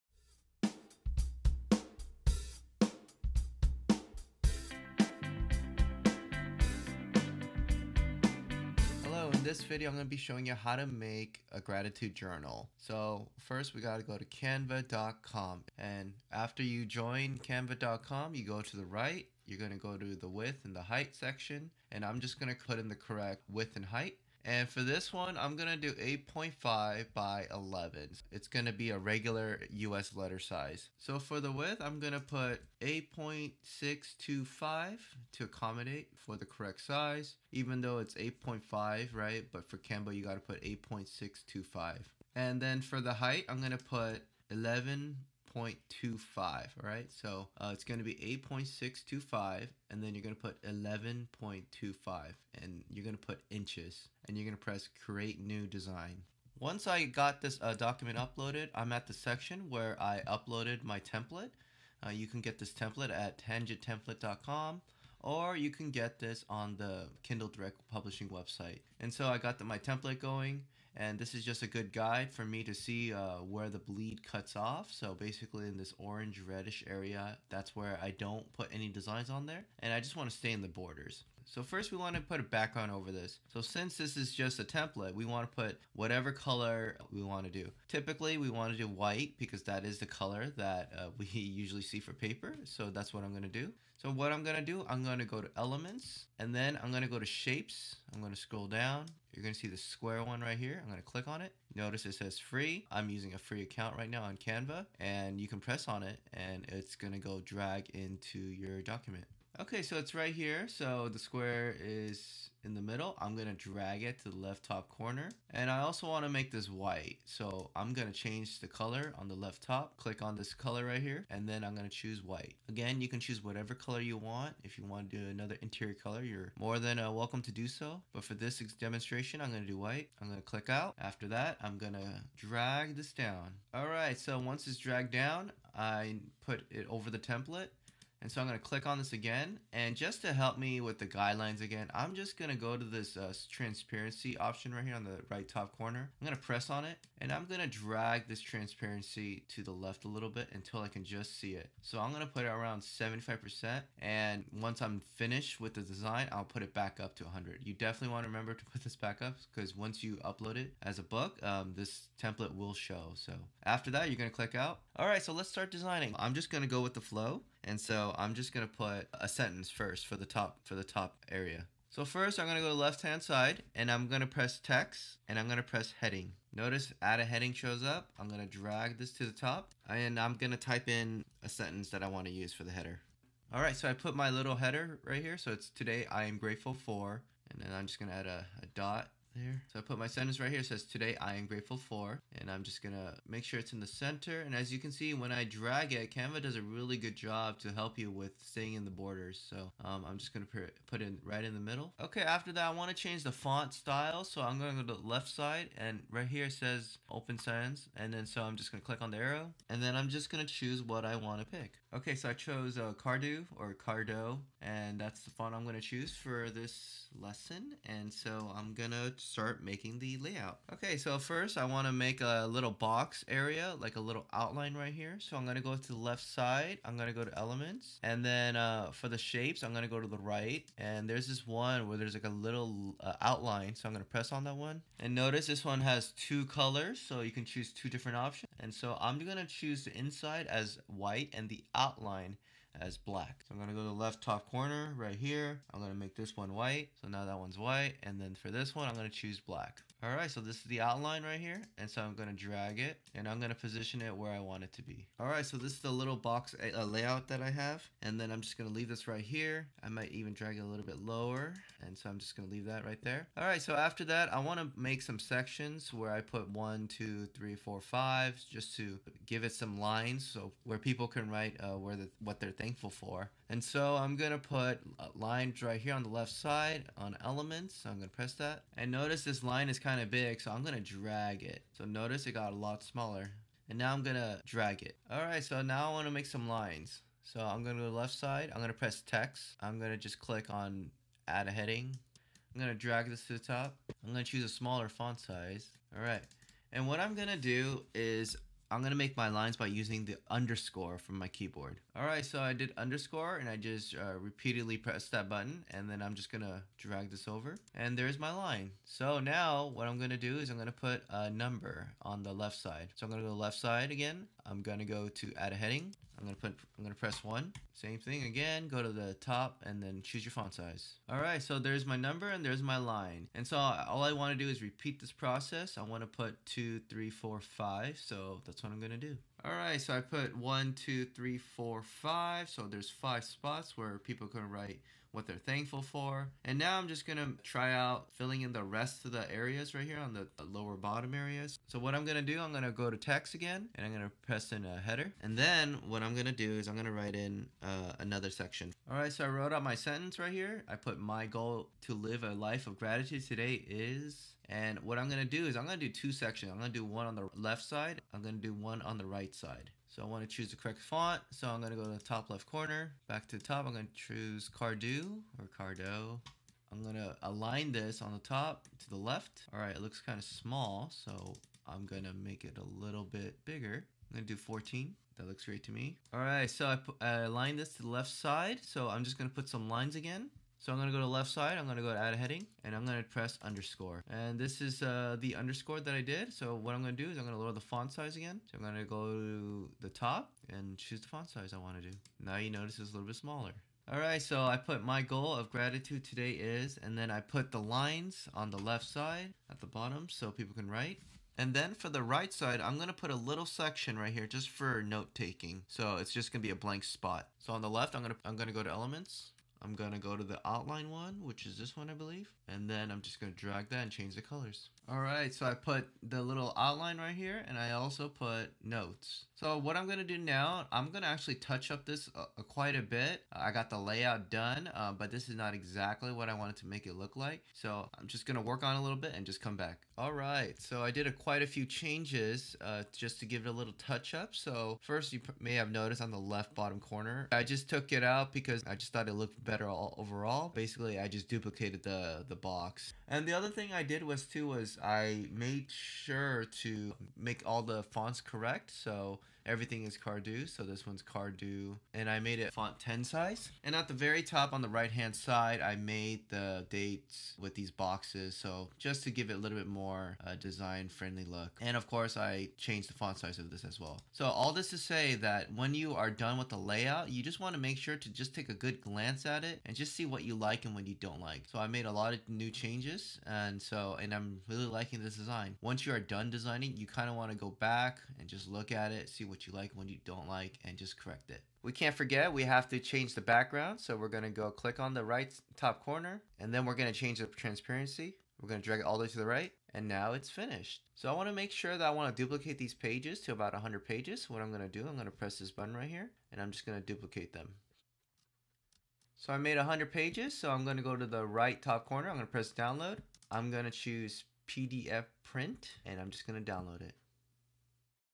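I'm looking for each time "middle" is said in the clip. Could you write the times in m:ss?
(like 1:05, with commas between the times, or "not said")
1:52, 3:21.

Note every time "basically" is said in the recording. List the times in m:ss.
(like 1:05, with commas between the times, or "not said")
1:15, 7:20.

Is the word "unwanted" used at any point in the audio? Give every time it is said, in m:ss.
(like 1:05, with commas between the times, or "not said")
not said.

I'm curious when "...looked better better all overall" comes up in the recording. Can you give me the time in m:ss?
7:19.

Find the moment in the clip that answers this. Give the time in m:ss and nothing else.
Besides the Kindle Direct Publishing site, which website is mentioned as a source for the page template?
1:03.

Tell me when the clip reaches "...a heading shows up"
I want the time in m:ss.
2:57.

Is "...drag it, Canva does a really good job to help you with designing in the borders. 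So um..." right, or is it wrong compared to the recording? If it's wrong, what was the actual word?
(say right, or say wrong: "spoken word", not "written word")
wrong: "staying", not "designing".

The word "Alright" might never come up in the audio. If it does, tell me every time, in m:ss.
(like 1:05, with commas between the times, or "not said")
5:21, 6:33.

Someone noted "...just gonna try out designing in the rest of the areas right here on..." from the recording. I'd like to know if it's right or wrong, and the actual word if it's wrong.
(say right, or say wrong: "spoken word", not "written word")
wrong: "filling", not "designing".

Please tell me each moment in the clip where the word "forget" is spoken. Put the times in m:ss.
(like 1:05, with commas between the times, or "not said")
8:01.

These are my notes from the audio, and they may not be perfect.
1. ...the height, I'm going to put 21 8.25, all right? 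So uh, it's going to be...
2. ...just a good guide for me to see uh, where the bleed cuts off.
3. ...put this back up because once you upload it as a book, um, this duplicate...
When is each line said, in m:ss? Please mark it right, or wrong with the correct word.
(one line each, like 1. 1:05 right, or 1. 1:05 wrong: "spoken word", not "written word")
1. 0:42 wrong: "11", not "21"
2. 1:11 right
3. 2:38 wrong: "template", not "duplicate".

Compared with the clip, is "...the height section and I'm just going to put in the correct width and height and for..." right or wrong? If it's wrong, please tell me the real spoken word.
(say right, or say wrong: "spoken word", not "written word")
right.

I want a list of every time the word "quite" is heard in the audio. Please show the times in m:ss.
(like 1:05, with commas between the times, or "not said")
7:02, 7:11.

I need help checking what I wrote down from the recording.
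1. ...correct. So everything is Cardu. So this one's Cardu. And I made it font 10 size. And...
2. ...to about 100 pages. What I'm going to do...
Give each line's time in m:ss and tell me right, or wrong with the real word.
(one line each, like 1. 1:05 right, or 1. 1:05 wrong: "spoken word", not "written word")
1. 7:28 right
2. 8:13 right.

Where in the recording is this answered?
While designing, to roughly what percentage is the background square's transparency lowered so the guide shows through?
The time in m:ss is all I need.
2:32.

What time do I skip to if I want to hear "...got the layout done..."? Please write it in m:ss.
7:03.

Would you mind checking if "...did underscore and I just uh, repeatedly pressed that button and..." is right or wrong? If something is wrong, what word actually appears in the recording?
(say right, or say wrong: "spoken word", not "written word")
right.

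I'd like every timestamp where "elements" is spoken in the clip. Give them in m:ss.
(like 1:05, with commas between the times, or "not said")
1:35, 3:47, 4:37, 6:48.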